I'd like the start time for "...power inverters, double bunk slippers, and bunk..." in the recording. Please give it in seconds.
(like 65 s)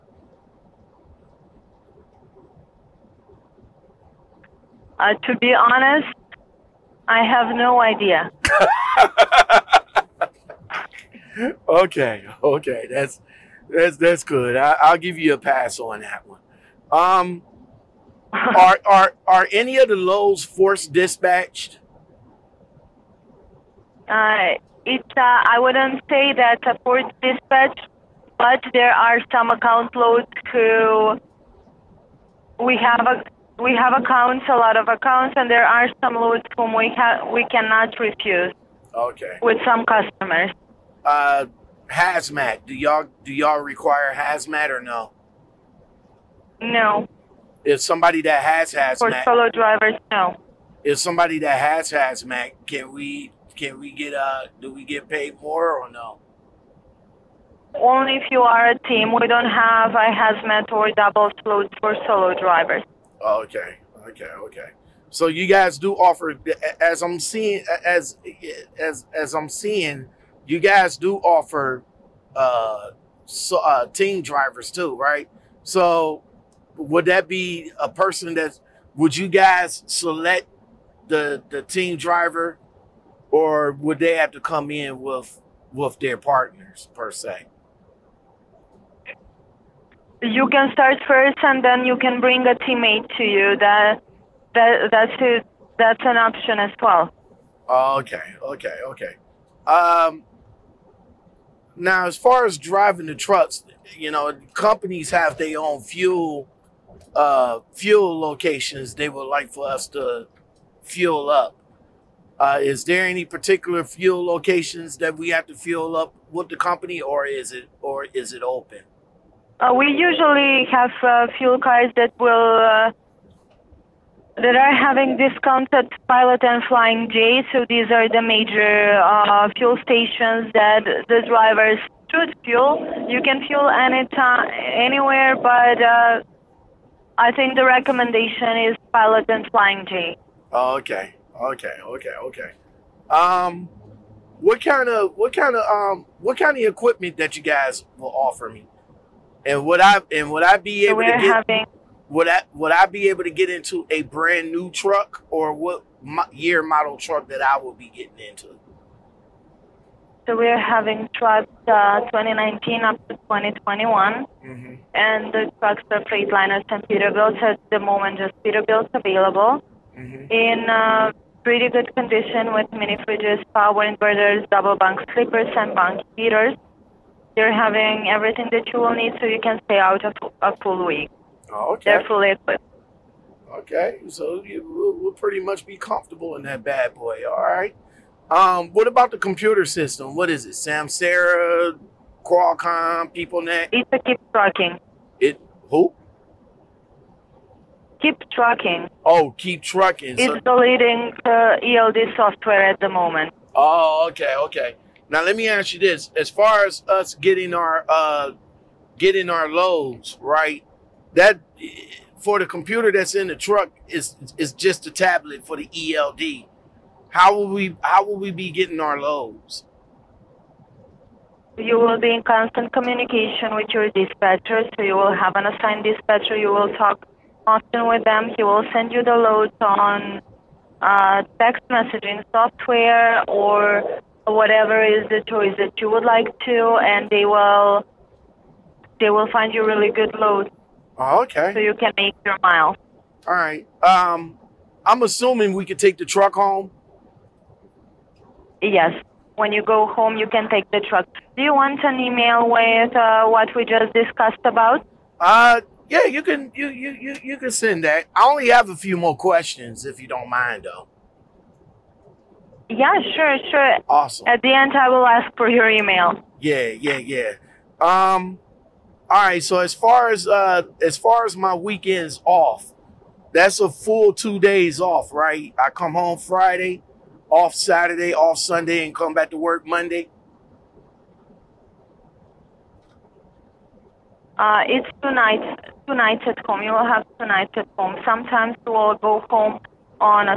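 173 s.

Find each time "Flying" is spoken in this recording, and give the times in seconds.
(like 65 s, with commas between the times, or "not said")
126 s, 139 s.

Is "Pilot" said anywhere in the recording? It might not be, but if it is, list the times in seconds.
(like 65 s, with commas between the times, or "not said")
126 s, 138 s.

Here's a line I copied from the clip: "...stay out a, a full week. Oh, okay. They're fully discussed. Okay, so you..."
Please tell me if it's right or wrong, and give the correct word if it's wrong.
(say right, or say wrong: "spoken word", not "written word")
wrong: "equipped", not "discussed".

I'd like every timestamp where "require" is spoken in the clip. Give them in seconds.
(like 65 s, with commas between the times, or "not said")
43 s.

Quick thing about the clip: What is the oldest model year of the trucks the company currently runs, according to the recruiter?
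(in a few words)
2019.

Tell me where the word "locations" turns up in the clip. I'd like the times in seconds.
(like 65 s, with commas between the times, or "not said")
108 s, 114 s.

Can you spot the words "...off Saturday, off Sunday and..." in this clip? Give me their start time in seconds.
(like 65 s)
277 s.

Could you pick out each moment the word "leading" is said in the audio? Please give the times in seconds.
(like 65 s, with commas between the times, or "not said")
200 s.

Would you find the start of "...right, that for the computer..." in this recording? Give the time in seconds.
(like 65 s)
210 s.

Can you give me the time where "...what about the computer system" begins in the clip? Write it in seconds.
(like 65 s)
188 s.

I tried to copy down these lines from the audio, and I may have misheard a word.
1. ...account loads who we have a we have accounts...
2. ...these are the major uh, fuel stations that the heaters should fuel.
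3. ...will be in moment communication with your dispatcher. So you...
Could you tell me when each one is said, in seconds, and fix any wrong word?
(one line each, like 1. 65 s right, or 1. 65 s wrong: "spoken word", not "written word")
1. 29 s right
2. 127 s wrong: "drivers", not "heaters"
3. 221 s wrong: "constant", not "moment".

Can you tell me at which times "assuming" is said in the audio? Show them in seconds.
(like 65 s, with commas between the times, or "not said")
245 s.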